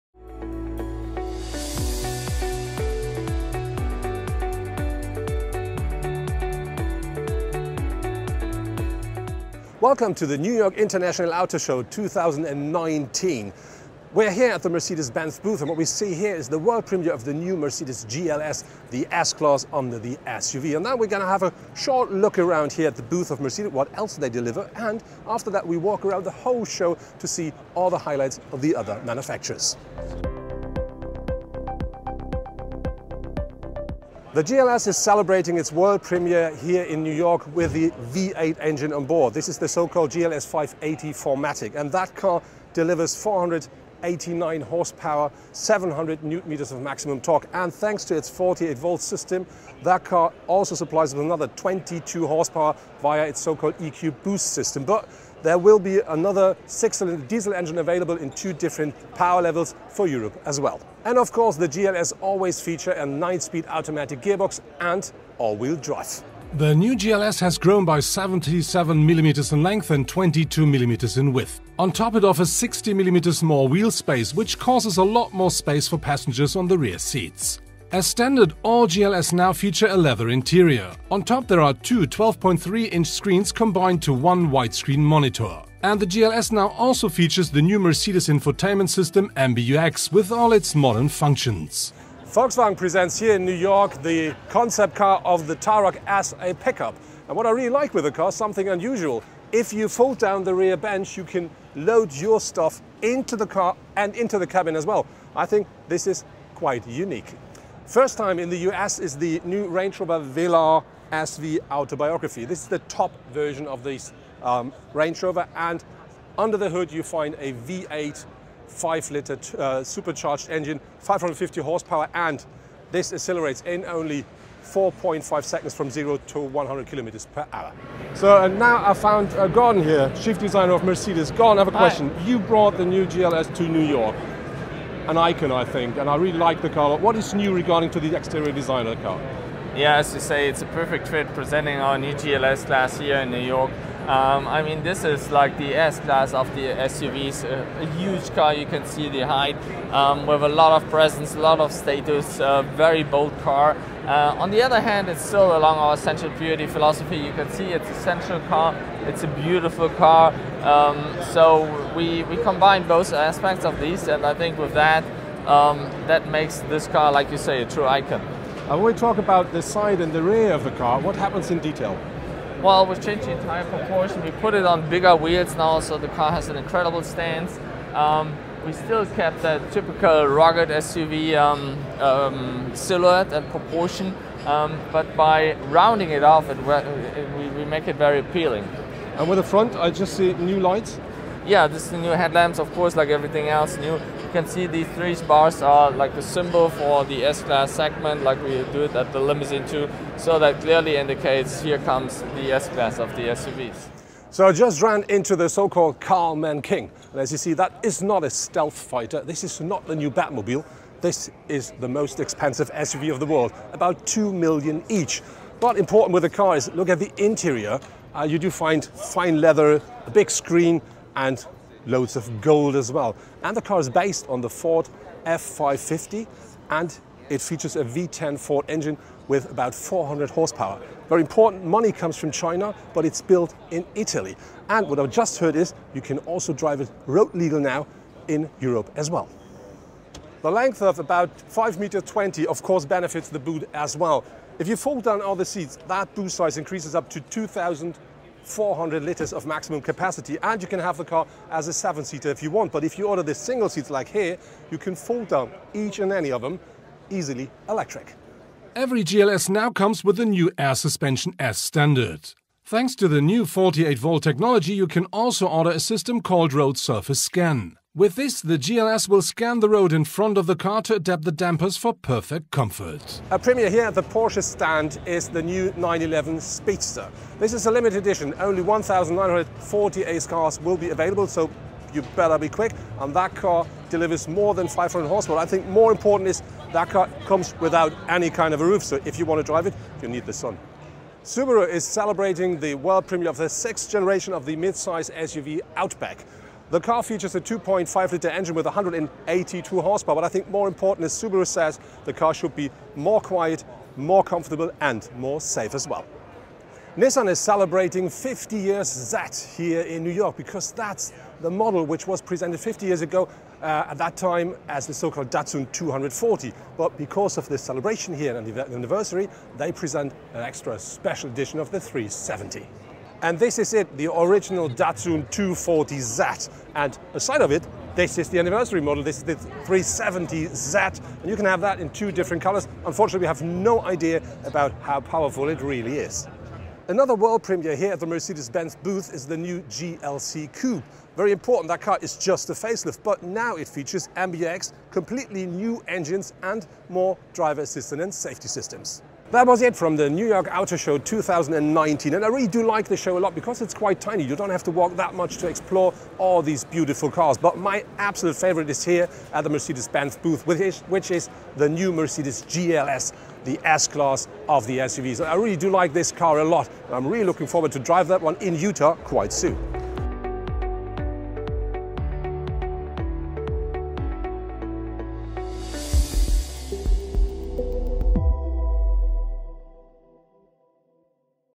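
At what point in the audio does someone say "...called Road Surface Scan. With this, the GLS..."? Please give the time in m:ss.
4:26.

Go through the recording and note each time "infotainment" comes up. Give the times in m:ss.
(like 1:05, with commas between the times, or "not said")
1:28.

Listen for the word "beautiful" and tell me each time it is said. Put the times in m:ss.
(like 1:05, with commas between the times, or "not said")
2:39, 5:56.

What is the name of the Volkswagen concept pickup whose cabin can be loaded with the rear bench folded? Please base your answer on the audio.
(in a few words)
Tarok.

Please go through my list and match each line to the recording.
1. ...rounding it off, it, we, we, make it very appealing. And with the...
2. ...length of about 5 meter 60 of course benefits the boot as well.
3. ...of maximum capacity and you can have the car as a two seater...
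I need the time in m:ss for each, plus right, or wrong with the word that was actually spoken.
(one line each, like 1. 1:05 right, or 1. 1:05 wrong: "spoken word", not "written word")
1. 3:05 right
2. 4:00 wrong: "20", not "60"
3. 4:09 wrong: "seven", not "two".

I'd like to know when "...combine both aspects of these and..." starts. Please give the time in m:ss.
2:42.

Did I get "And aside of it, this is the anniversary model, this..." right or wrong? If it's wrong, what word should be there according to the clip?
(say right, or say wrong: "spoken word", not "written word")
right.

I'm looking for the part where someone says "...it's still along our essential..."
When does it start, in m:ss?
2:35.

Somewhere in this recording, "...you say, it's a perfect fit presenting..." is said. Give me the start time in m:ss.
2:20.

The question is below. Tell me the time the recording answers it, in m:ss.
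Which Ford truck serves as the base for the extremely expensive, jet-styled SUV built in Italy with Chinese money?
3:44.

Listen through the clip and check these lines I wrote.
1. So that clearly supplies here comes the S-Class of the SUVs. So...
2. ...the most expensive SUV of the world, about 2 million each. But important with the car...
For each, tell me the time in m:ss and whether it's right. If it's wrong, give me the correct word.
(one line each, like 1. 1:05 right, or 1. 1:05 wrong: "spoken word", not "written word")
1. 3:20 wrong: "indicates", not "supplies"
2. 3:31 right.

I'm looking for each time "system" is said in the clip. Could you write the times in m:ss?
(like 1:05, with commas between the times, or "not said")
0:49, 0:54, 1:28, 4:25, 5:48.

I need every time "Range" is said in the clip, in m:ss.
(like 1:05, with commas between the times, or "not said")
1:49, 1:54.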